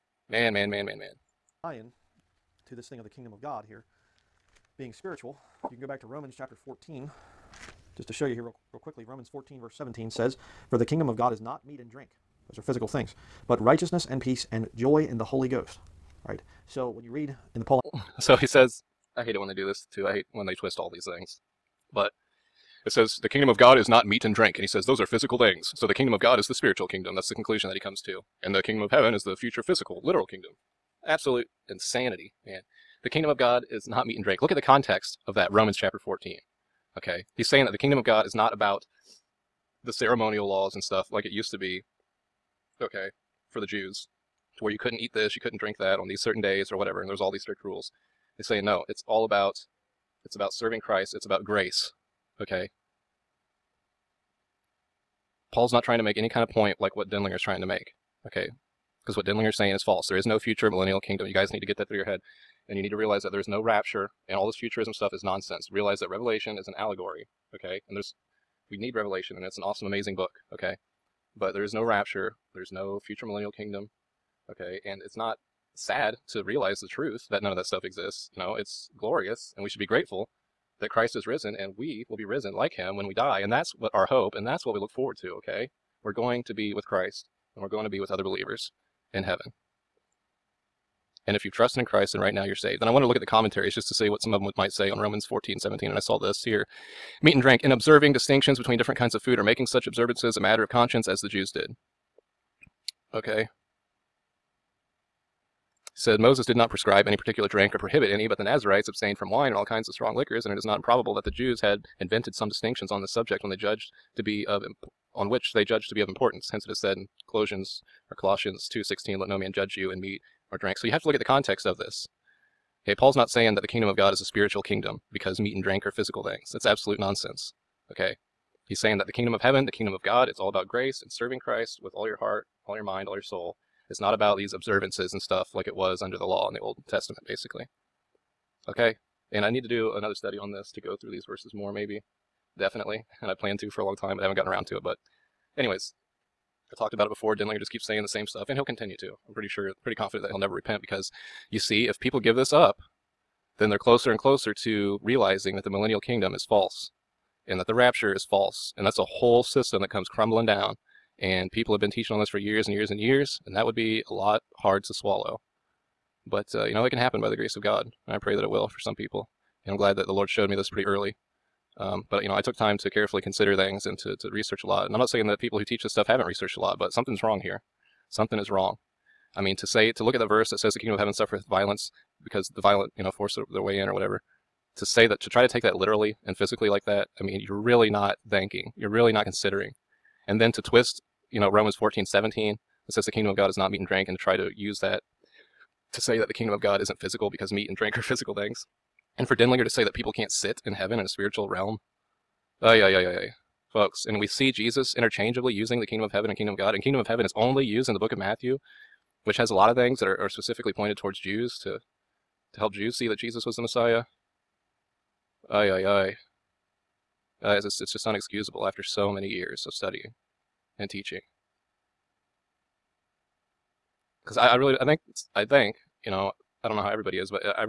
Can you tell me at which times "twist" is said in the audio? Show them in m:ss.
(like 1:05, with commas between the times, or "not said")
0:20, 3:10.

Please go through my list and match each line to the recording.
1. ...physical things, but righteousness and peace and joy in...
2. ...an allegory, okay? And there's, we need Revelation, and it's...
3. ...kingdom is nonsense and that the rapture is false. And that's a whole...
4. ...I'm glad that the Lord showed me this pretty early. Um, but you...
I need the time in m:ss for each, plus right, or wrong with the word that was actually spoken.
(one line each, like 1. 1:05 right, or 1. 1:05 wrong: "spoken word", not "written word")
1. 0:12 right
2. 1:06 right
3. 2:35 wrong: "false", not "nonsense"
4. 2:49 right.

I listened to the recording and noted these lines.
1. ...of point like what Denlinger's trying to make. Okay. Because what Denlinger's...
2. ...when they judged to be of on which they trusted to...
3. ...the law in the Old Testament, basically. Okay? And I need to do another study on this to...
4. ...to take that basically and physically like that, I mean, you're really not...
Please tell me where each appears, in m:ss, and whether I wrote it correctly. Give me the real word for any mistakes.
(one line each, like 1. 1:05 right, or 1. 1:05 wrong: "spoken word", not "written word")
1. 0:56 right
2. 1:53 wrong: "judged", not "trusted"
3. 2:16 right
4. 3:05 wrong: "literally", not "basically".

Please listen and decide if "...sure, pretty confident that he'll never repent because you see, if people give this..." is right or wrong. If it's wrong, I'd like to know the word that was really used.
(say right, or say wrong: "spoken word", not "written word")
right.